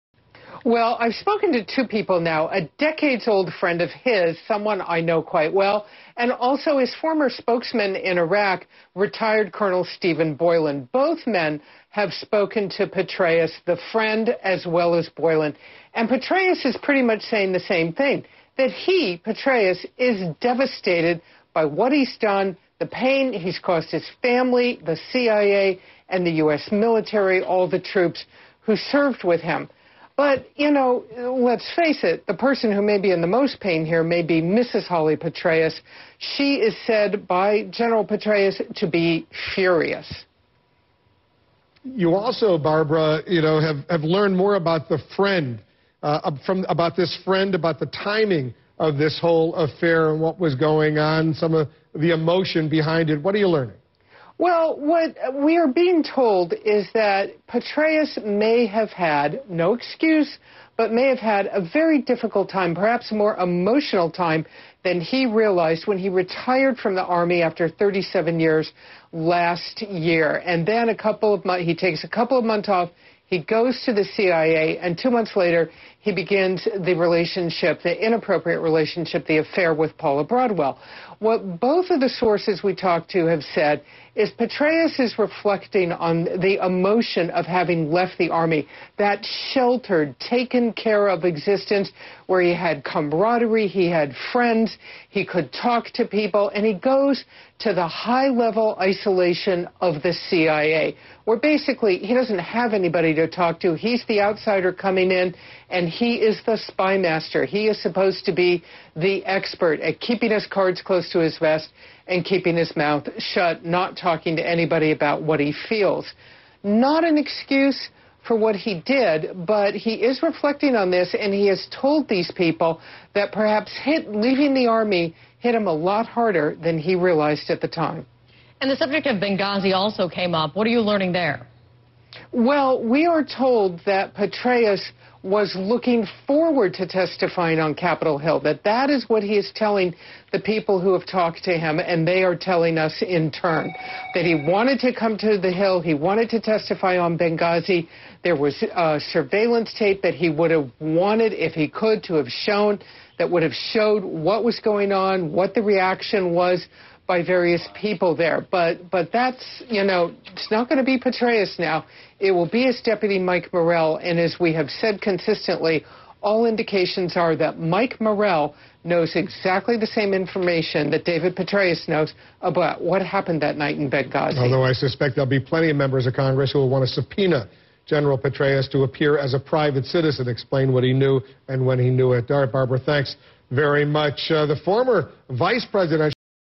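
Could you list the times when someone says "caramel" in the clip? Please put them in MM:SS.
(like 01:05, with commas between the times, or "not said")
not said.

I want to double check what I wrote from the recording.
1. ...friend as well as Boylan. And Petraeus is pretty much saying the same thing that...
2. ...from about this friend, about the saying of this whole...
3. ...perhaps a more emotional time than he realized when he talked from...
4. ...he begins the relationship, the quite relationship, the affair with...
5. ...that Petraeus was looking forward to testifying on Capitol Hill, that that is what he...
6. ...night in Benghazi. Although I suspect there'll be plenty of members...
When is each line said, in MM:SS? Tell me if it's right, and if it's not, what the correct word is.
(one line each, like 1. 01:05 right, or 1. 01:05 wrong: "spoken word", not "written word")
1. 00:13 right
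2. 00:46 wrong: "timing", not "saying"
3. 01:02 wrong: "retired", not "talked"
4. 01:16 wrong: "inappropriate", not "quite"
5. 02:13 right
6. 02:53 right.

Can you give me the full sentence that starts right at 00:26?
military, all the troops who served with him.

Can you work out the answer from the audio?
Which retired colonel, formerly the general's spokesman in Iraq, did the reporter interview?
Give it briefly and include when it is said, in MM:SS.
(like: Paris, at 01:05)
Stephen Boylan, at 00:09.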